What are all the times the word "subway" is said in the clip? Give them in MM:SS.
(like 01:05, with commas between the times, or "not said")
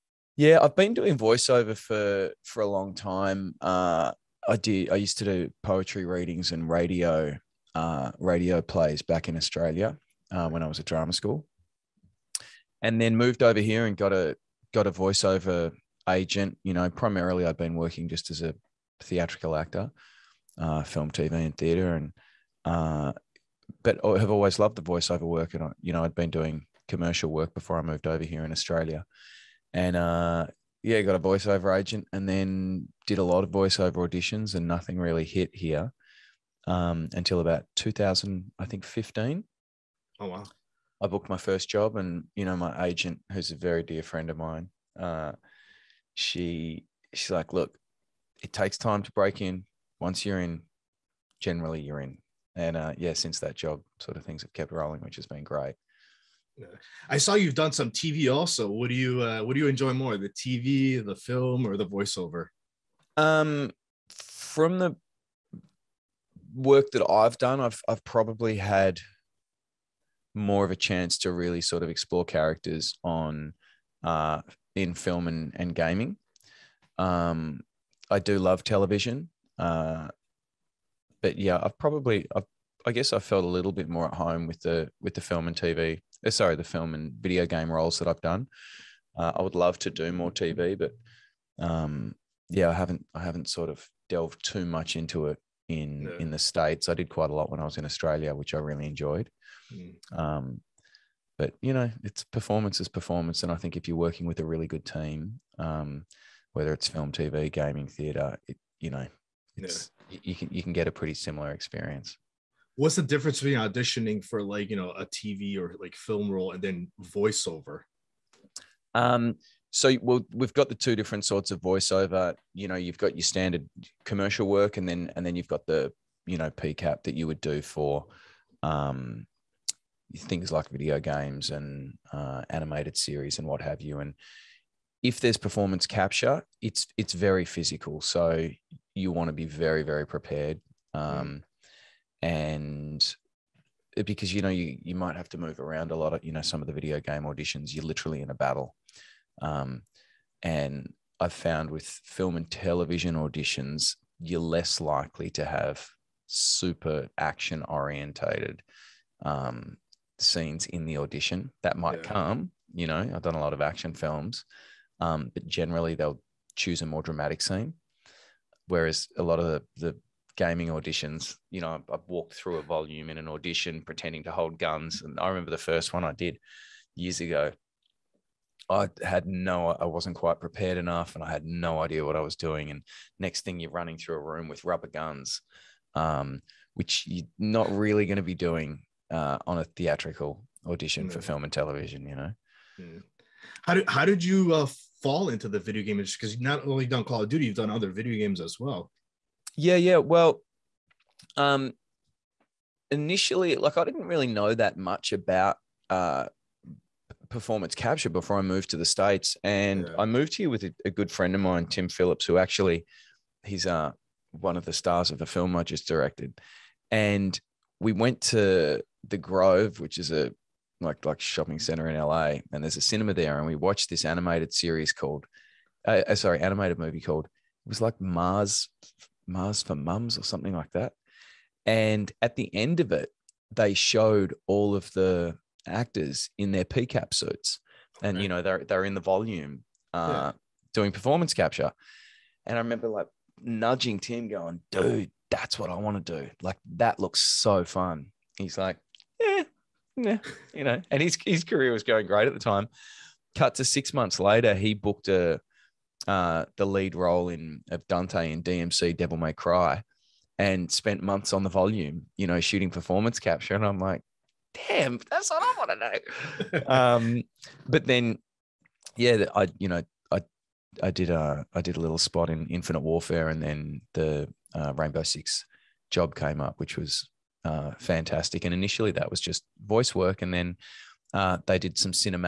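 not said.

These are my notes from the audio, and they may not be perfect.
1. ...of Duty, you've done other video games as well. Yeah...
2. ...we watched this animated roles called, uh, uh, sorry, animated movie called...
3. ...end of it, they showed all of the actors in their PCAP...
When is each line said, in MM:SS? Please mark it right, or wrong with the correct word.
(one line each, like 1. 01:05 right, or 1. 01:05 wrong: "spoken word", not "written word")
1. 03:17 right
2. 03:43 wrong: "series", not "roles"
3. 03:52 right.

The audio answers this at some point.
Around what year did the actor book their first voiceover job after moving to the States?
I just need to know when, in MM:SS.
00:37.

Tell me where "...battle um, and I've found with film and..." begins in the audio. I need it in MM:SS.
02:28.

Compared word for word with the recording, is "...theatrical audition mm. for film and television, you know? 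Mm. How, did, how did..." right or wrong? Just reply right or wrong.
right.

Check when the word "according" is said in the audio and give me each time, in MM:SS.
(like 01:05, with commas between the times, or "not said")
not said.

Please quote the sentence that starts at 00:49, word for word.
Once you're in, generally you're in.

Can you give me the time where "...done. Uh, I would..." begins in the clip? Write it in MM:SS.
01:28.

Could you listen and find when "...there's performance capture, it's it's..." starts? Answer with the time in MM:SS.
02:15.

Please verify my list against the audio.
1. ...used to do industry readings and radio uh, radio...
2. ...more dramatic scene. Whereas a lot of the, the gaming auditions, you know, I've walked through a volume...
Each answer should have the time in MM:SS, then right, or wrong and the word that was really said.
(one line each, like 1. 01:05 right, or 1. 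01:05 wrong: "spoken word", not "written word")
1. 00:04 wrong: "poetry", not "industry"
2. 02:46 right.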